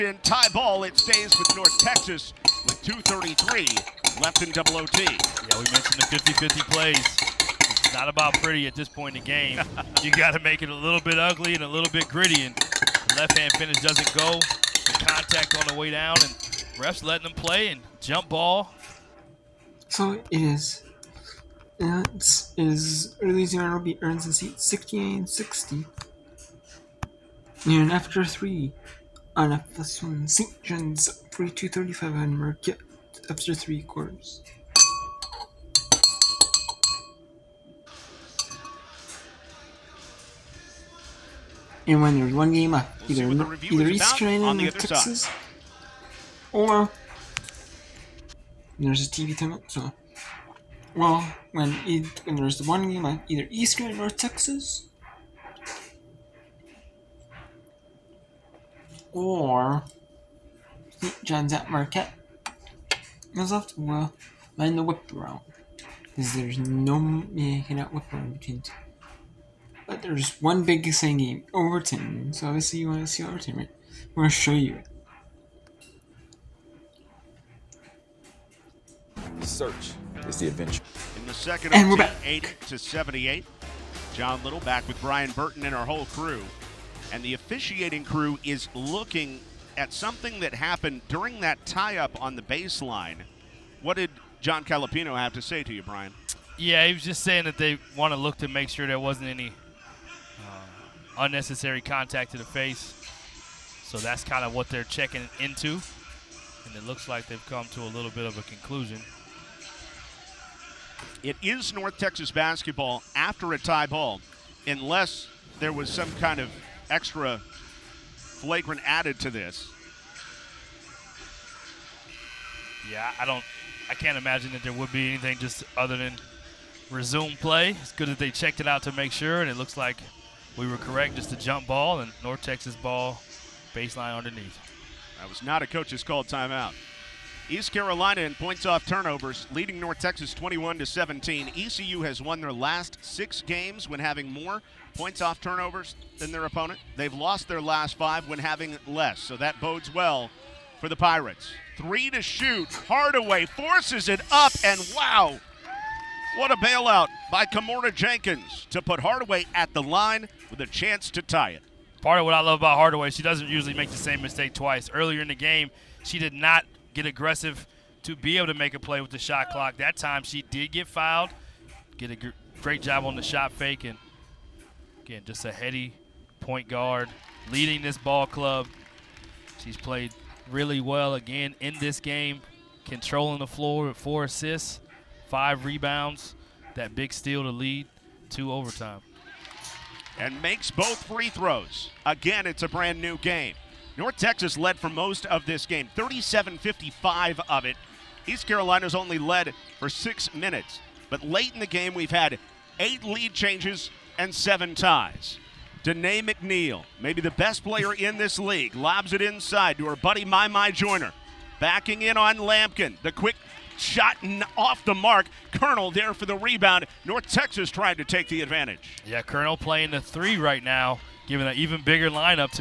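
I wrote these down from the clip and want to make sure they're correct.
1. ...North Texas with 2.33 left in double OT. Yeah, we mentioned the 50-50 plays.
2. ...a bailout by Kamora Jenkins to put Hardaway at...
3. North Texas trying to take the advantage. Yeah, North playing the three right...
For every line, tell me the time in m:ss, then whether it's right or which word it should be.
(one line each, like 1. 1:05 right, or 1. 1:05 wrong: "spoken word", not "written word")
1. 0:01 right
2. 2:36 right
3. 3:37 wrong: "Colonel", not "North".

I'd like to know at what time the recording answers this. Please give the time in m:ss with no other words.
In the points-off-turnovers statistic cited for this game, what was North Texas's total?
2:20.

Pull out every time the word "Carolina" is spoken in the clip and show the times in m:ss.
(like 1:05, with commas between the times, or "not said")
0:44, 2:17, 3:18.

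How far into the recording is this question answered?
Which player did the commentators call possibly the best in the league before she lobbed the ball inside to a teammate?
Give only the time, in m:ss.
3:25.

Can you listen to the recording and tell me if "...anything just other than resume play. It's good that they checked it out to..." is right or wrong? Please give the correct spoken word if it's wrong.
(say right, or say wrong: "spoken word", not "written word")
right.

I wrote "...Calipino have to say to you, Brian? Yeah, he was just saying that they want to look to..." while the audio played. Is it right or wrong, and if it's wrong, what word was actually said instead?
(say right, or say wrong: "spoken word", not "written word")
right.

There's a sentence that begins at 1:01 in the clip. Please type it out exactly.
John's at Marquette, is left well, run the whip around.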